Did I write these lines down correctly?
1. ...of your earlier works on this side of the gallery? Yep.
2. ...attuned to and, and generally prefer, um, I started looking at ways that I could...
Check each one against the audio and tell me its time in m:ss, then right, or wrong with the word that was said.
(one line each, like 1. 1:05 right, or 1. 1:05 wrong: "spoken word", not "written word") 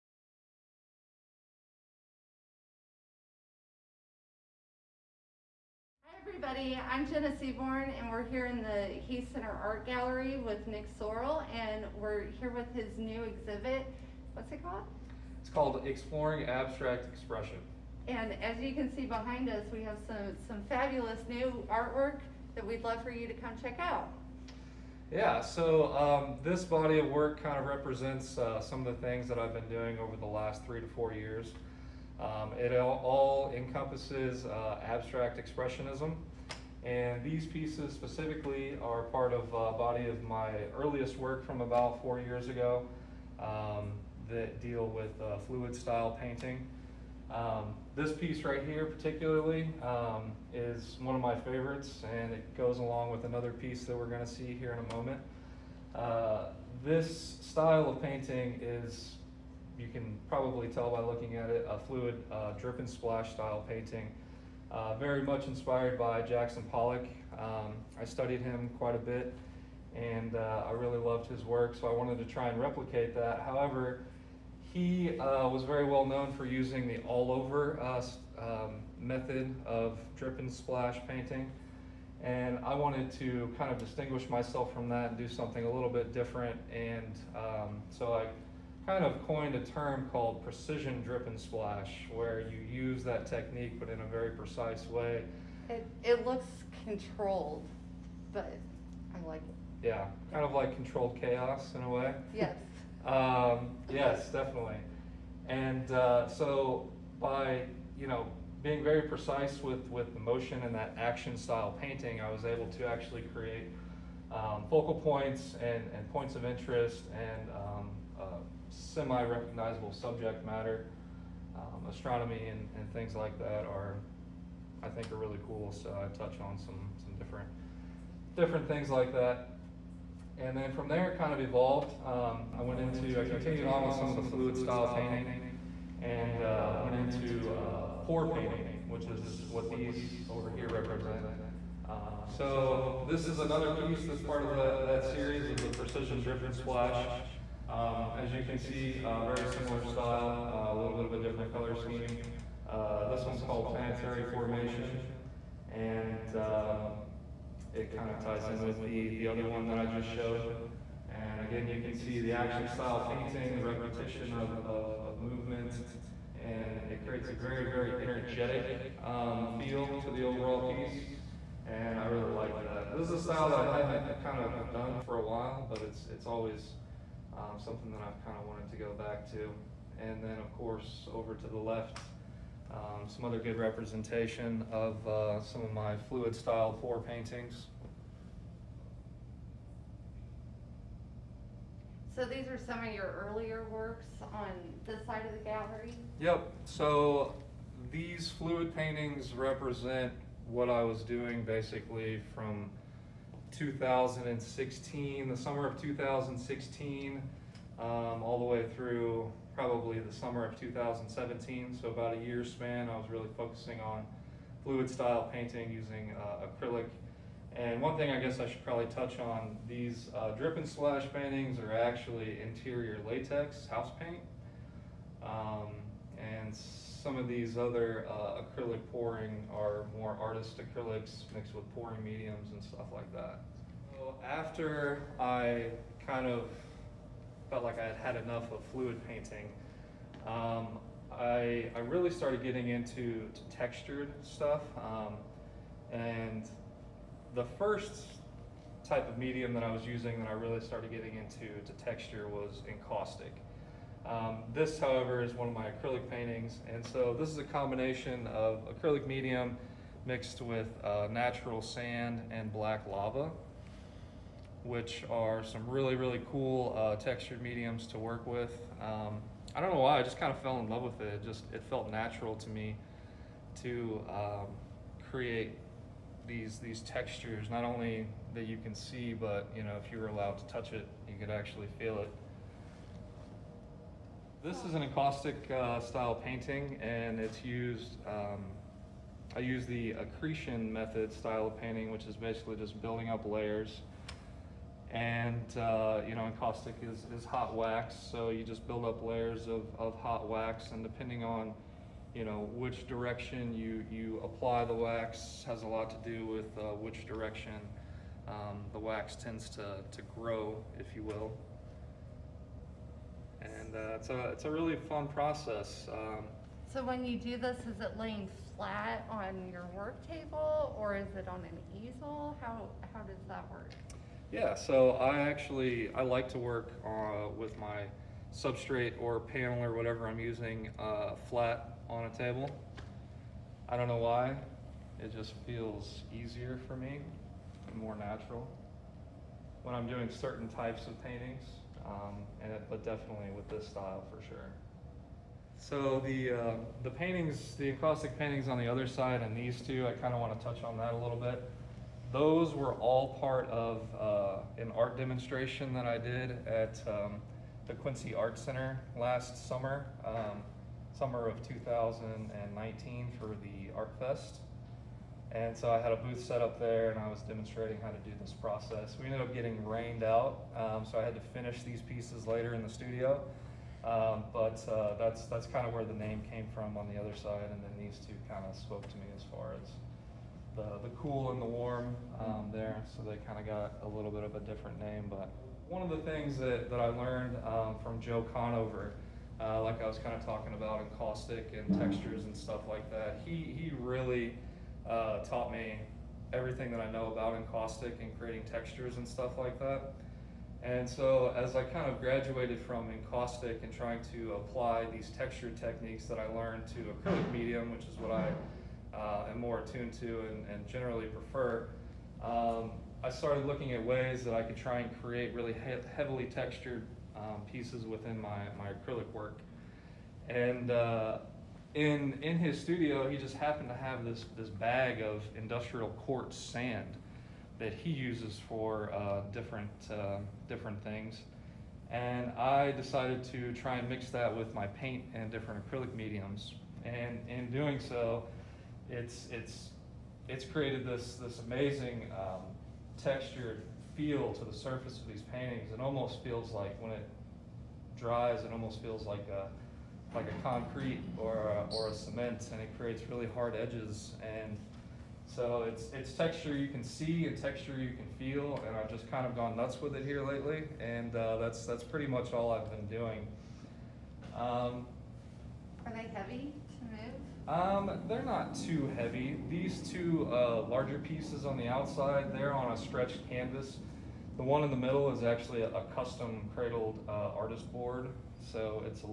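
1. 3:12 right
2. 6:49 right.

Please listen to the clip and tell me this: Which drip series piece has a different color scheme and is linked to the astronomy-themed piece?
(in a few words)
Planetary Formation.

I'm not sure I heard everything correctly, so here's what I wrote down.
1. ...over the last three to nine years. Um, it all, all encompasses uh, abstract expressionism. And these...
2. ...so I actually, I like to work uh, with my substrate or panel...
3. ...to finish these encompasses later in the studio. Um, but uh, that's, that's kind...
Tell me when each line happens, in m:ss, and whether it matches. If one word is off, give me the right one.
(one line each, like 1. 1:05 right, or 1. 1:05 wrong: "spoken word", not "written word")
1. 0:29 wrong: "four", not "nine"
2. 5:24 right
3. 6:11 wrong: "pieces", not "encompasses".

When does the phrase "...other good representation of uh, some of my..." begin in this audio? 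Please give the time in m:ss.
3:03.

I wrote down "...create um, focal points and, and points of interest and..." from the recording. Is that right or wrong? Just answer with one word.
right.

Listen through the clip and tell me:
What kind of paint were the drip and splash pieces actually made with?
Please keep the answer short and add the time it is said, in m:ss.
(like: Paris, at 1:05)
interior latex house paint, at 3:42.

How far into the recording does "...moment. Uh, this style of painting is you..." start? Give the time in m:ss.
0:54.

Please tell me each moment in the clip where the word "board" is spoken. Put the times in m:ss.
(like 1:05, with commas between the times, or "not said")
7:57.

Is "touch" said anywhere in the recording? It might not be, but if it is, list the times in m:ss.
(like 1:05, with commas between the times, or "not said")
2:06, 3:38, 4:40, 5:50.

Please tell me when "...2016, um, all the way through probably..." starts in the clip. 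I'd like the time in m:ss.
3:25.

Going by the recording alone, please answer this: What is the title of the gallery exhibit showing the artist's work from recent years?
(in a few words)
Exploring Abstract Expression.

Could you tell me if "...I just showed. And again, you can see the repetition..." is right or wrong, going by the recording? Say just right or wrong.
wrong.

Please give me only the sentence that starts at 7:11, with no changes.
And I decided to try and mix that with my paint and different acrylic mediums.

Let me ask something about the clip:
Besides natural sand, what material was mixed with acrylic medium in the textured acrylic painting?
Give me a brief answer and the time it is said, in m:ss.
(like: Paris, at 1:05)
black lava, at 4:22.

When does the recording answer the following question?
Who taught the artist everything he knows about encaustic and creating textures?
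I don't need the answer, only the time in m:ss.
6:28.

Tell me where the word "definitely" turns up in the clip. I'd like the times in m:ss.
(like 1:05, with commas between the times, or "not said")
1:44, 5:42.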